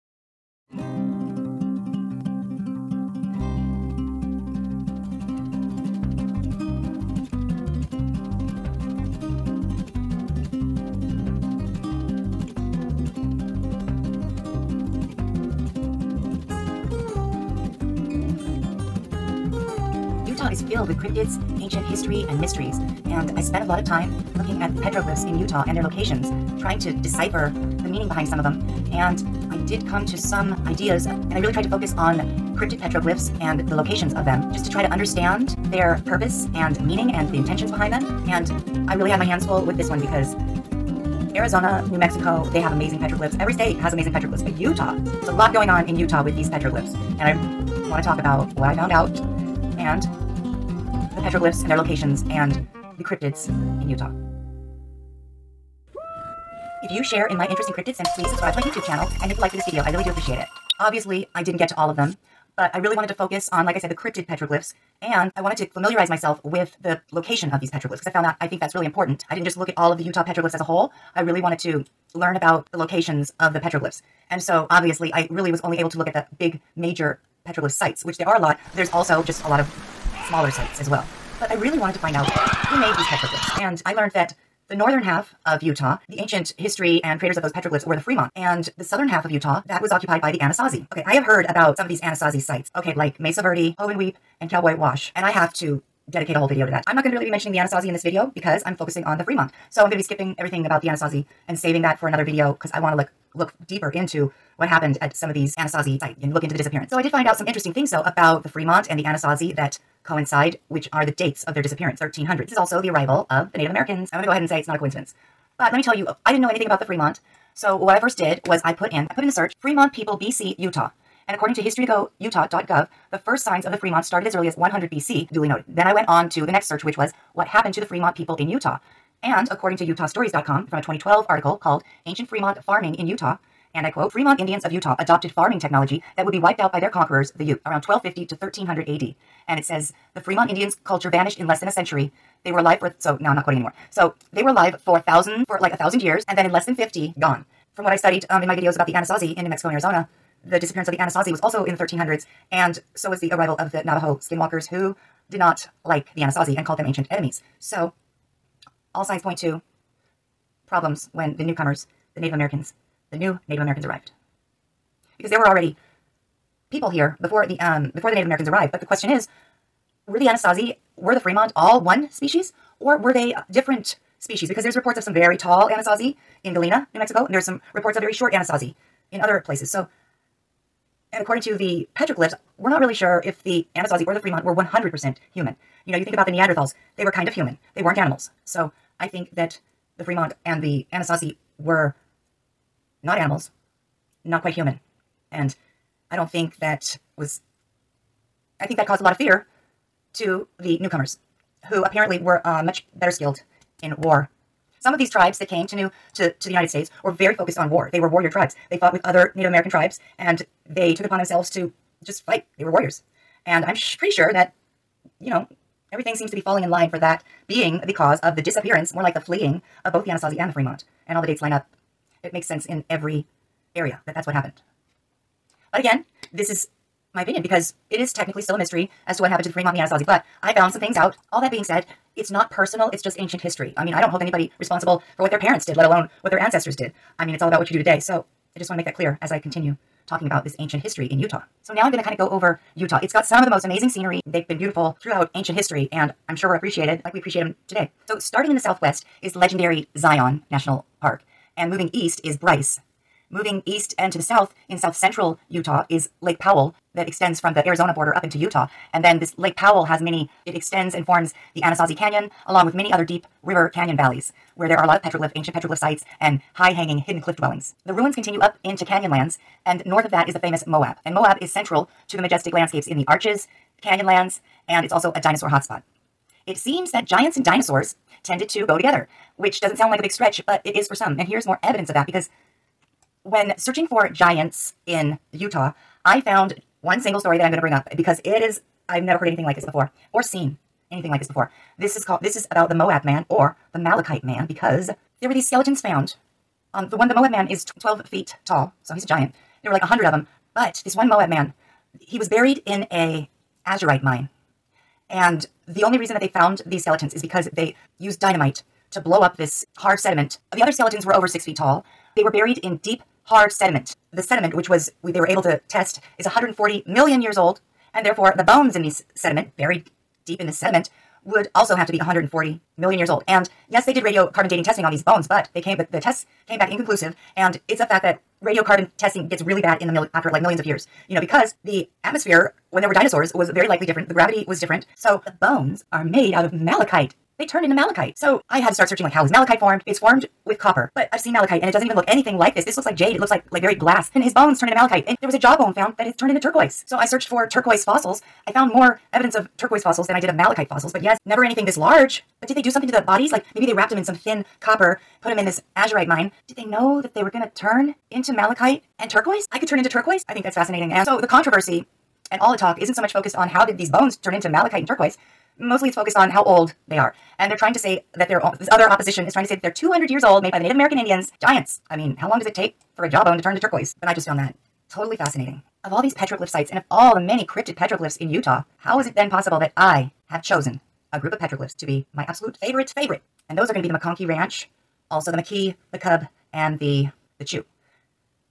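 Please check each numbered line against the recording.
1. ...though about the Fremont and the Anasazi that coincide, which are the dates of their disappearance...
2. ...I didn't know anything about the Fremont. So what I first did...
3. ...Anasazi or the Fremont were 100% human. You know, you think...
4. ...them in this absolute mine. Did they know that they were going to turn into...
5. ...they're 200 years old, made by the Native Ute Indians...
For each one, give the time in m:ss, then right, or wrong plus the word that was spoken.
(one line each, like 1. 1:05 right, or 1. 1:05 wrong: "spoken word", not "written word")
1. 1:47 right
2. 1:56 right
3. 3:03 right
4. 5:55 wrong: "azurite", not "absolute"
5. 6:09 wrong: "American", not "Ute".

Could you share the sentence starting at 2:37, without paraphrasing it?
So, all signs point to problems when the newcomers, the Native Americans, the new Native Americans arrived.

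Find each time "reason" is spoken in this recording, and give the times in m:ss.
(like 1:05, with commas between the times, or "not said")
5:05.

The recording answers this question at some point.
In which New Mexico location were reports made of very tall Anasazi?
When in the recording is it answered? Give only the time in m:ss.
2:56.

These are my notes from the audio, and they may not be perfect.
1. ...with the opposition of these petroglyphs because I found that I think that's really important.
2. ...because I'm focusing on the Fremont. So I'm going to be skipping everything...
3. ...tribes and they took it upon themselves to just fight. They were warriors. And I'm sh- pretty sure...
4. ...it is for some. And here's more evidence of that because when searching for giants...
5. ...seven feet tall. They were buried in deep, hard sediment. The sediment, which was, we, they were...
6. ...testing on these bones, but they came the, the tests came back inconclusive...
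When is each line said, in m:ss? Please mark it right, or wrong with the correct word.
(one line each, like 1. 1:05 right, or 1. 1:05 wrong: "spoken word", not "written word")
1. 1:06 wrong: "location", not "opposition"
2. 1:38 right
3. 3:29 right
4. 4:40 right
5. 5:11 wrong: "six", not "seven"
6. 5:24 right.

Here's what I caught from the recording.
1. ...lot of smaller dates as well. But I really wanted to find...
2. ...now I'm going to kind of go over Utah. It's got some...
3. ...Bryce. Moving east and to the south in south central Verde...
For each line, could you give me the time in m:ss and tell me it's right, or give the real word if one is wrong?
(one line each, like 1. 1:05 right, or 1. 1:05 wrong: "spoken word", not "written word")
1. 1:19 wrong: "sites", not "dates"
2. 4:01 right
3. 4:12 wrong: "Utah", not "Verde".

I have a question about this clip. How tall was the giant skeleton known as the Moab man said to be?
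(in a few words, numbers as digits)
12 feet.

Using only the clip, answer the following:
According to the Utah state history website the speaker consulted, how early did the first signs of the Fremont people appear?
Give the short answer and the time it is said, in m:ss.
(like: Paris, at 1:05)
100 BC, at 2:04.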